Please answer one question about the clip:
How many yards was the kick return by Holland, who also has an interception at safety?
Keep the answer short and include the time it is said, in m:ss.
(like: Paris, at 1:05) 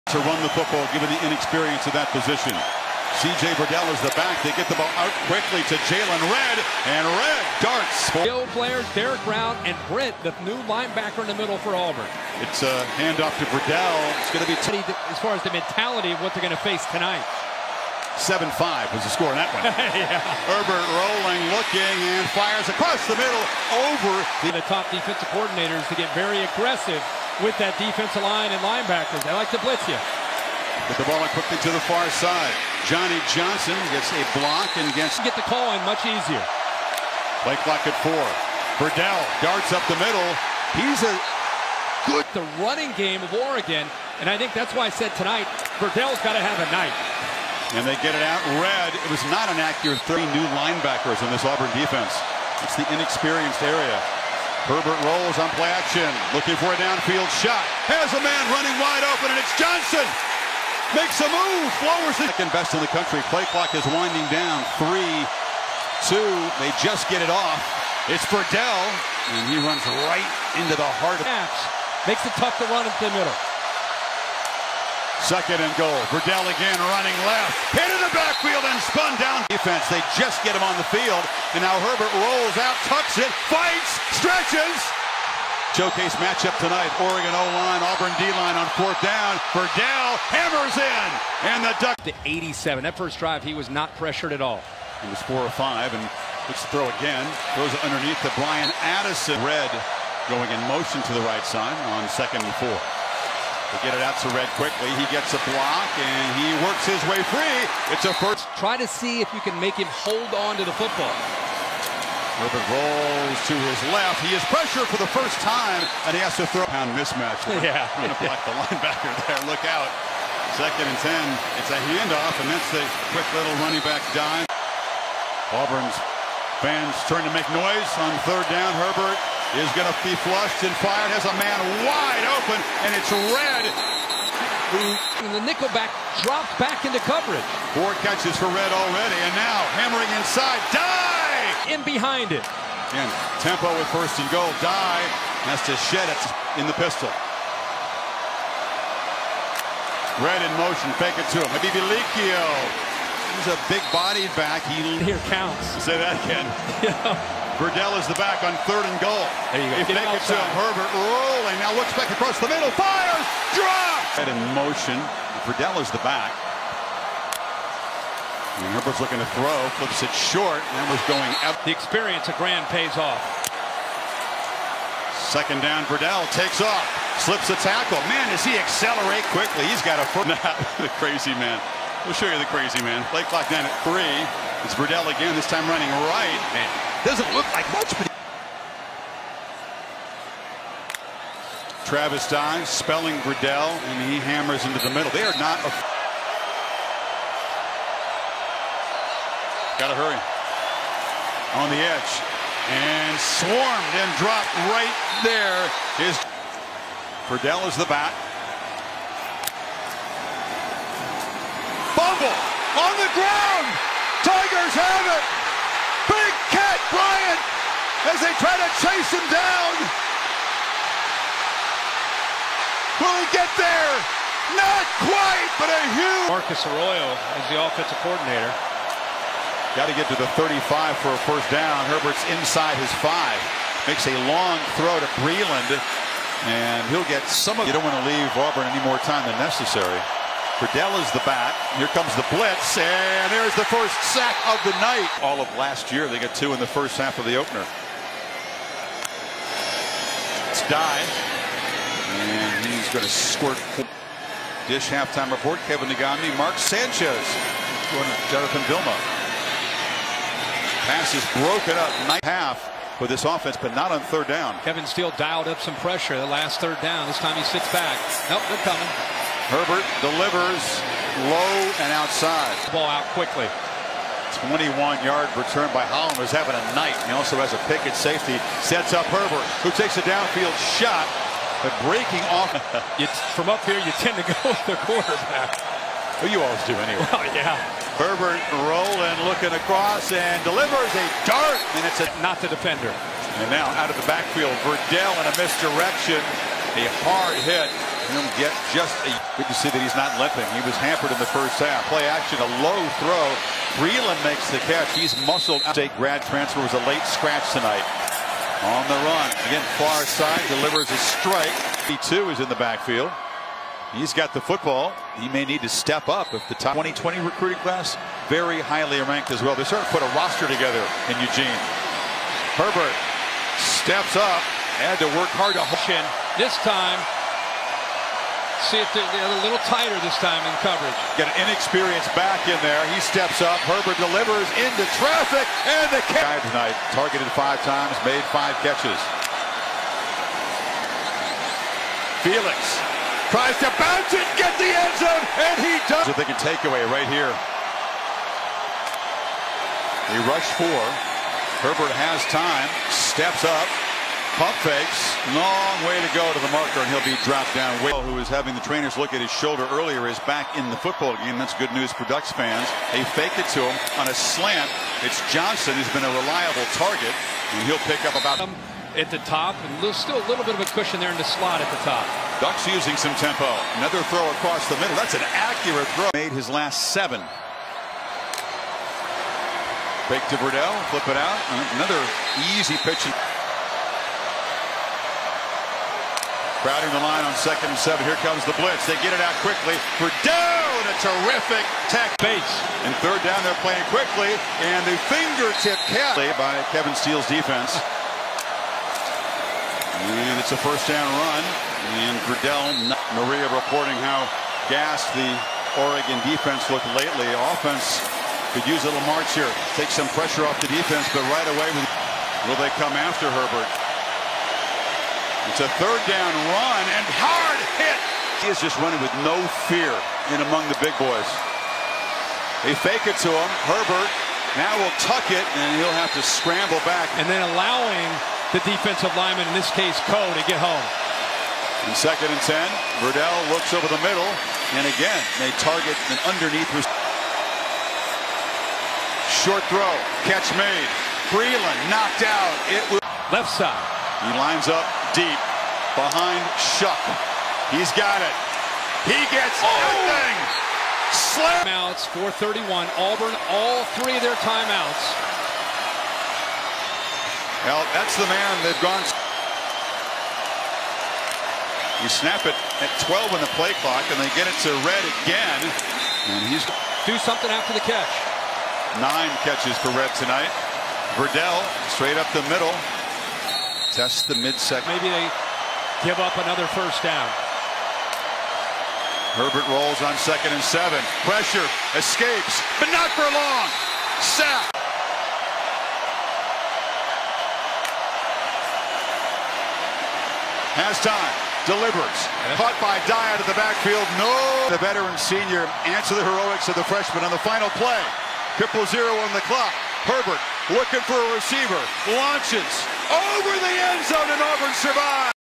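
21, at 4:34.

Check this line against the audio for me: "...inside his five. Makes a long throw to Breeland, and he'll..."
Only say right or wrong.
right.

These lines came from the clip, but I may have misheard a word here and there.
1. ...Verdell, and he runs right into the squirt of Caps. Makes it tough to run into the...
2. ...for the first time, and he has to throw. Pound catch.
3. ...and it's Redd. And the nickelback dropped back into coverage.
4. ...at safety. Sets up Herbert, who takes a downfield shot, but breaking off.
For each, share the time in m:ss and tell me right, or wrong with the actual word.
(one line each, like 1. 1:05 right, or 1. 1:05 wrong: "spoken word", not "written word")
1. 1:08 wrong: "heart", not "squirt"
2. 1:54 wrong: "mismatch", not "catch"
3. 2:12 right
4. 4:37 right.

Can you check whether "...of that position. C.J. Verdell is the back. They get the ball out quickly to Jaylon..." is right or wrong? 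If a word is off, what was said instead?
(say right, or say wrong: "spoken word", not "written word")
right.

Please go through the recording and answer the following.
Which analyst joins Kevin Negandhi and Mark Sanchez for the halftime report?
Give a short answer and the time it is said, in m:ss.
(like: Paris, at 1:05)
Jonathan Vilma, at 4:18.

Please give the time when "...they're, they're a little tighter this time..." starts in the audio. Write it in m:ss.
5:28.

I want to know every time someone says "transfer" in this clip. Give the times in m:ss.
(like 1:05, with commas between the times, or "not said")
5:06.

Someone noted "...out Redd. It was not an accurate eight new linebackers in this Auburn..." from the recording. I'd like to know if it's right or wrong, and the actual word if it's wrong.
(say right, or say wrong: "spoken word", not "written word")
wrong: "three", not "eight".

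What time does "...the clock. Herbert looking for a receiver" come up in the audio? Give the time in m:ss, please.
8:19.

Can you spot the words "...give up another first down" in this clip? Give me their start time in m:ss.
7:56.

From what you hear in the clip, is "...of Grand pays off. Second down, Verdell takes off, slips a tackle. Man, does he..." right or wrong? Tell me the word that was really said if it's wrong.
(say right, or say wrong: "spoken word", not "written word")
right.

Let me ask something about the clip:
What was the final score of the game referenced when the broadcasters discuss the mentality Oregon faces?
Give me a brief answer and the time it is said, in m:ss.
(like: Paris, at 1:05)
7-5, at 0:18.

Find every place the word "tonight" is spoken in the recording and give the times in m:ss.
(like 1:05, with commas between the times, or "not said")
0:16, 0:45, 1:26, 5:07, 5:36, 7:50.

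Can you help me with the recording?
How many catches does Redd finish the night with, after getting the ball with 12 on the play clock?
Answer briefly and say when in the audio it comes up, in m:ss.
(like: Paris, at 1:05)
9, at 7:49.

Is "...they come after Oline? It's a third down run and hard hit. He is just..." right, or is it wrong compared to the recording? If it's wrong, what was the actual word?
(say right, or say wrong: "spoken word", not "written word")
wrong: "Herbert", not "Oline".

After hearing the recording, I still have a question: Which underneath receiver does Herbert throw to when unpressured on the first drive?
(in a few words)
Bryan Addison.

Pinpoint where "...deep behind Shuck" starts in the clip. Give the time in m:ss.
7:25.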